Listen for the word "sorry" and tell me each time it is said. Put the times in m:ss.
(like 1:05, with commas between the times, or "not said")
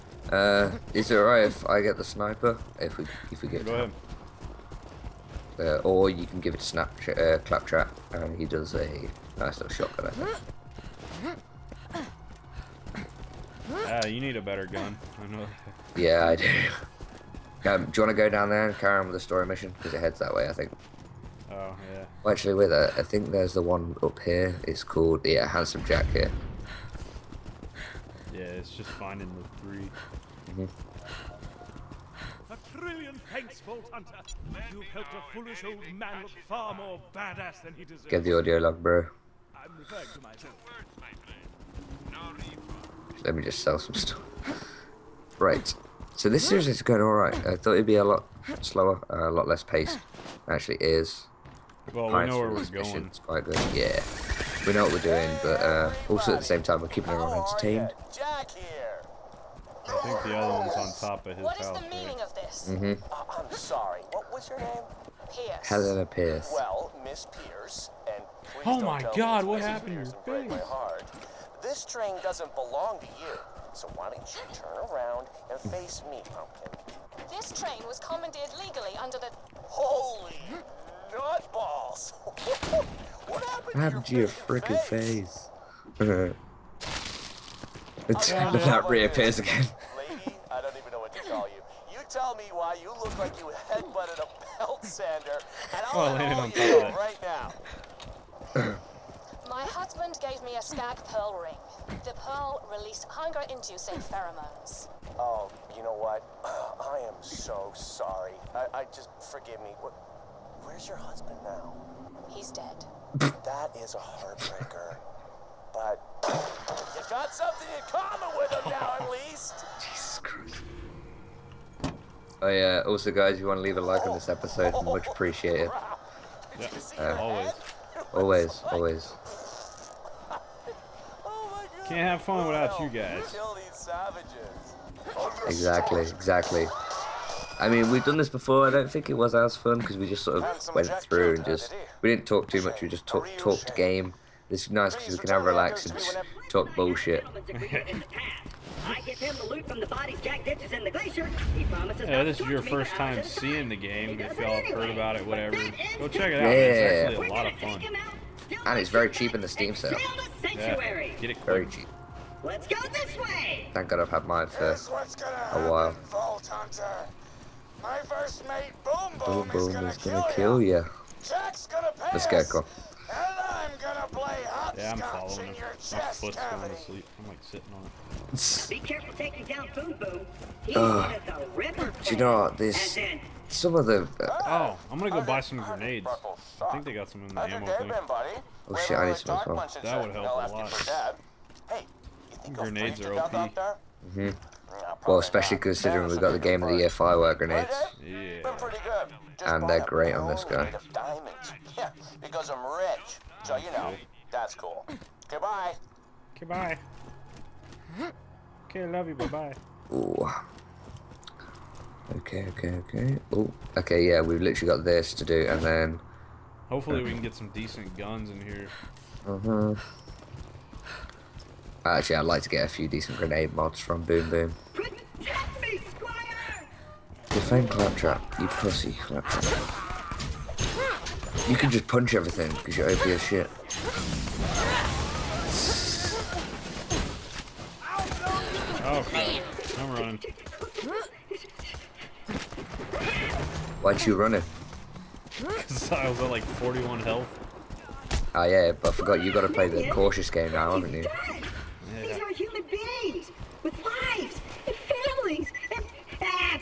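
1:03, 1:47.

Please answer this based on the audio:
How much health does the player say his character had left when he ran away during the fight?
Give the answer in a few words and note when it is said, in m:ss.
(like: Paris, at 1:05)
41, at 4:06.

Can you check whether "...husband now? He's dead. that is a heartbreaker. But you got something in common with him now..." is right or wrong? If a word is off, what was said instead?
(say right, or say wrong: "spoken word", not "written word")
right.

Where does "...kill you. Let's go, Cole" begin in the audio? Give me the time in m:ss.
2:50.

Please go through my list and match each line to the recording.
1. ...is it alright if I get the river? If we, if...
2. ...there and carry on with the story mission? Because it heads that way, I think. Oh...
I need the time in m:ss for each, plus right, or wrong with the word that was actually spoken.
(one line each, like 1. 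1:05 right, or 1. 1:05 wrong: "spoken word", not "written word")
1. 0:00 wrong: "sniper", not "river"
2. 0:18 right.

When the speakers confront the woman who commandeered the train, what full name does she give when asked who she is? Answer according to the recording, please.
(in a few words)
Helena Pierce.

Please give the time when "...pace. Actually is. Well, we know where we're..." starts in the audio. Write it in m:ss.
0:49.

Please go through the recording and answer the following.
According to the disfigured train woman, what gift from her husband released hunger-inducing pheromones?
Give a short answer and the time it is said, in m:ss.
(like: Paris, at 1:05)
A stag pearl ring, at 1:40.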